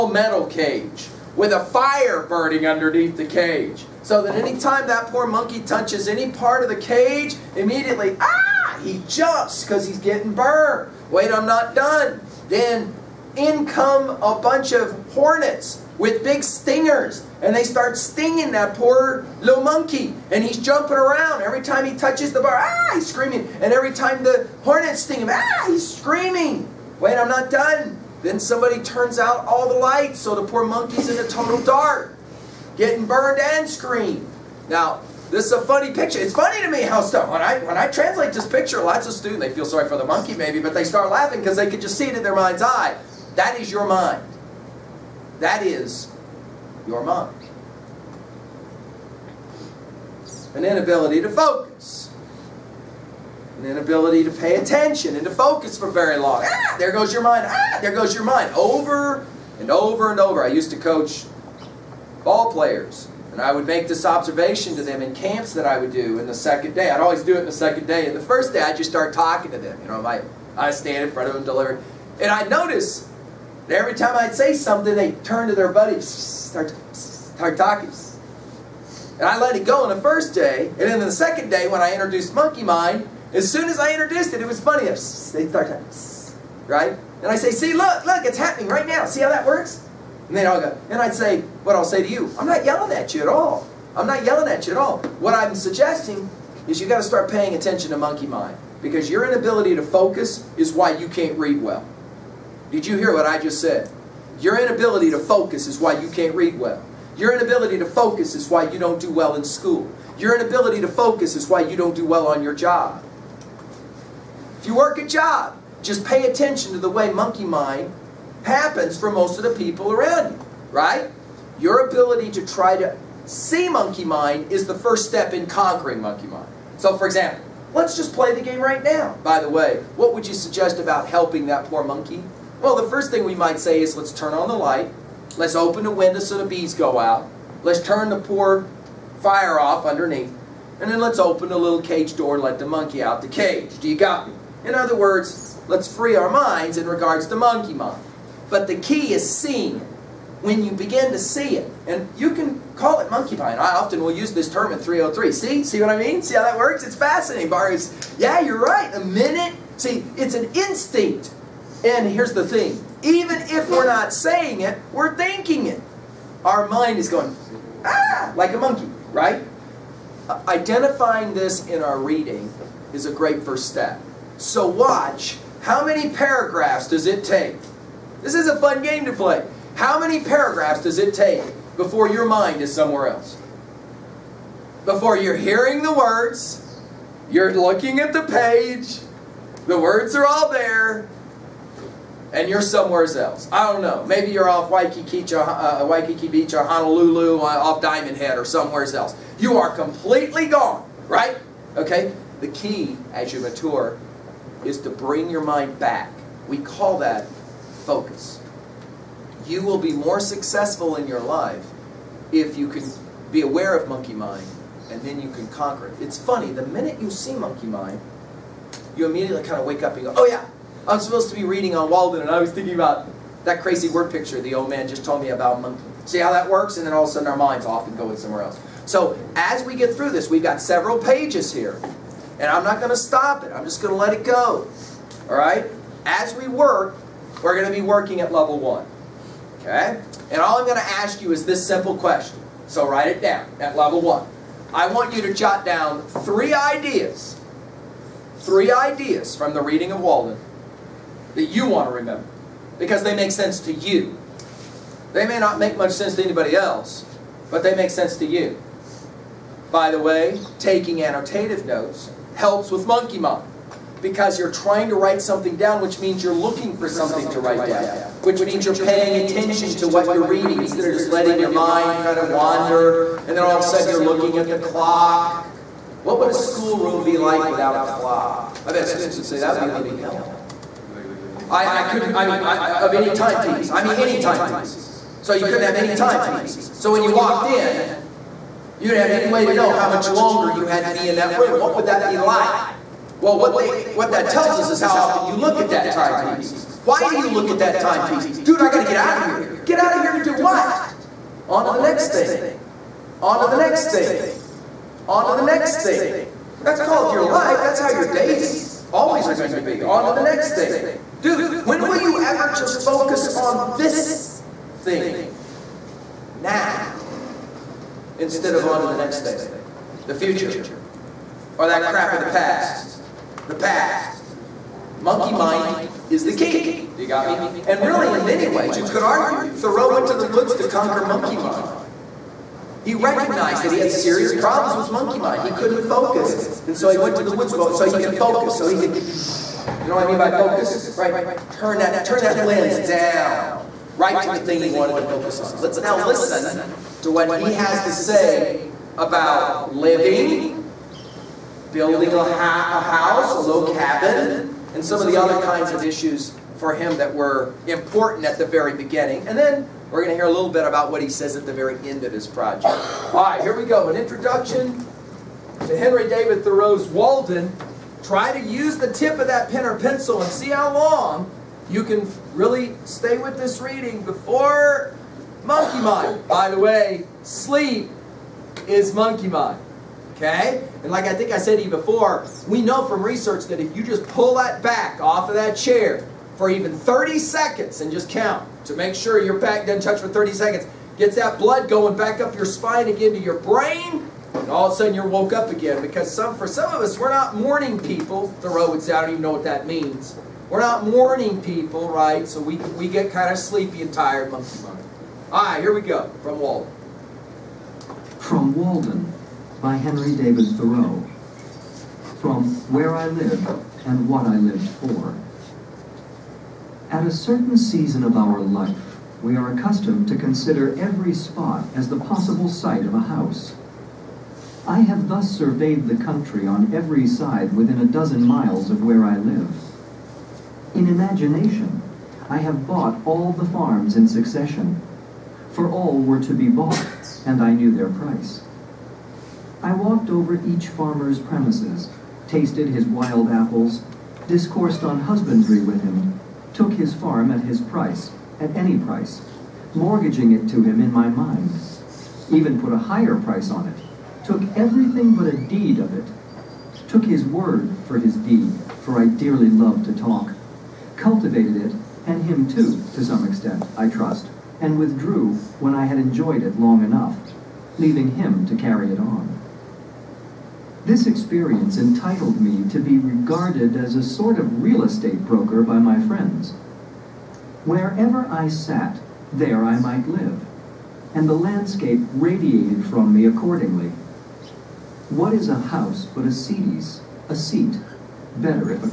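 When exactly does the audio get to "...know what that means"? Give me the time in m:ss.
6:39.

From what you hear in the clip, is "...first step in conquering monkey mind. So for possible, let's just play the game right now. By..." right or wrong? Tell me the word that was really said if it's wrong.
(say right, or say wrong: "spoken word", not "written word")
wrong: "example", not "possible".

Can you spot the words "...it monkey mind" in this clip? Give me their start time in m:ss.
2:32.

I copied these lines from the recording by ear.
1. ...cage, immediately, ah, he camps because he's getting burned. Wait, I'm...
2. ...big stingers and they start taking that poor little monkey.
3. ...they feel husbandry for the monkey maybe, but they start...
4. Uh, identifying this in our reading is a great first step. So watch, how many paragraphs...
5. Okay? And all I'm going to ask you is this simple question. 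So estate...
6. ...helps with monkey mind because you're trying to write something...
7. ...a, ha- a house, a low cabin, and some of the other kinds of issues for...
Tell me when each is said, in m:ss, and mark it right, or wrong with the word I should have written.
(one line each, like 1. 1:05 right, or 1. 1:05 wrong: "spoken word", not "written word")
1. 0:06 wrong: "jumps", not "camps"
2. 0:16 wrong: "stinging", not "taking"
3. 0:39 wrong: "sorry", not "husbandry"
4. 2:50 right
5. 3:59 wrong: "write", not "estate"
6. 4:22 right
7. 5:52 right.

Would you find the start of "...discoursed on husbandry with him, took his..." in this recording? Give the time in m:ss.
7:24.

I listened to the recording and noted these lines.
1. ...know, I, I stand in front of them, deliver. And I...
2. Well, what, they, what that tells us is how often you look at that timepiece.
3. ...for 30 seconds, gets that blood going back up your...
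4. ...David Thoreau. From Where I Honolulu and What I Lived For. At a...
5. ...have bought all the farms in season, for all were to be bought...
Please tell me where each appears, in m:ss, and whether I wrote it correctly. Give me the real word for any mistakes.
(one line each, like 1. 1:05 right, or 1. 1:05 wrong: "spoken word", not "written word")
1. 1:09 right
2. 4:53 right
3. 6:30 right
4. 6:50 wrong: "Live", not "Honolulu"
5. 7:12 wrong: "succession", not "season".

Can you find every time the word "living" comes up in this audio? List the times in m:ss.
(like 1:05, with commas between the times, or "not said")
4:39, 5:49.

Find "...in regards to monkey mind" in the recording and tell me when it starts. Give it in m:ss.
2:26.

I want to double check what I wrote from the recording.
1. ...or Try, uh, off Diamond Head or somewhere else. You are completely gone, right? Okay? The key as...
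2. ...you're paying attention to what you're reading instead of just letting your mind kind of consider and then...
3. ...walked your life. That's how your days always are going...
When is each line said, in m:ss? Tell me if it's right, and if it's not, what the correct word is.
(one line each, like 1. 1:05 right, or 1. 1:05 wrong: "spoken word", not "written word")
1. 3:16 wrong: "Honolulu", not "Try"
2. 4:28 wrong: "wander", not "consider"
3. 5:06 wrong: "called", not "walked".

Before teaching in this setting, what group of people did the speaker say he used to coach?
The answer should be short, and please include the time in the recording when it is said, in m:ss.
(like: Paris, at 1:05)
ball players, at 1:02.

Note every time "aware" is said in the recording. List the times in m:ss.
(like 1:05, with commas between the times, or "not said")
3:33.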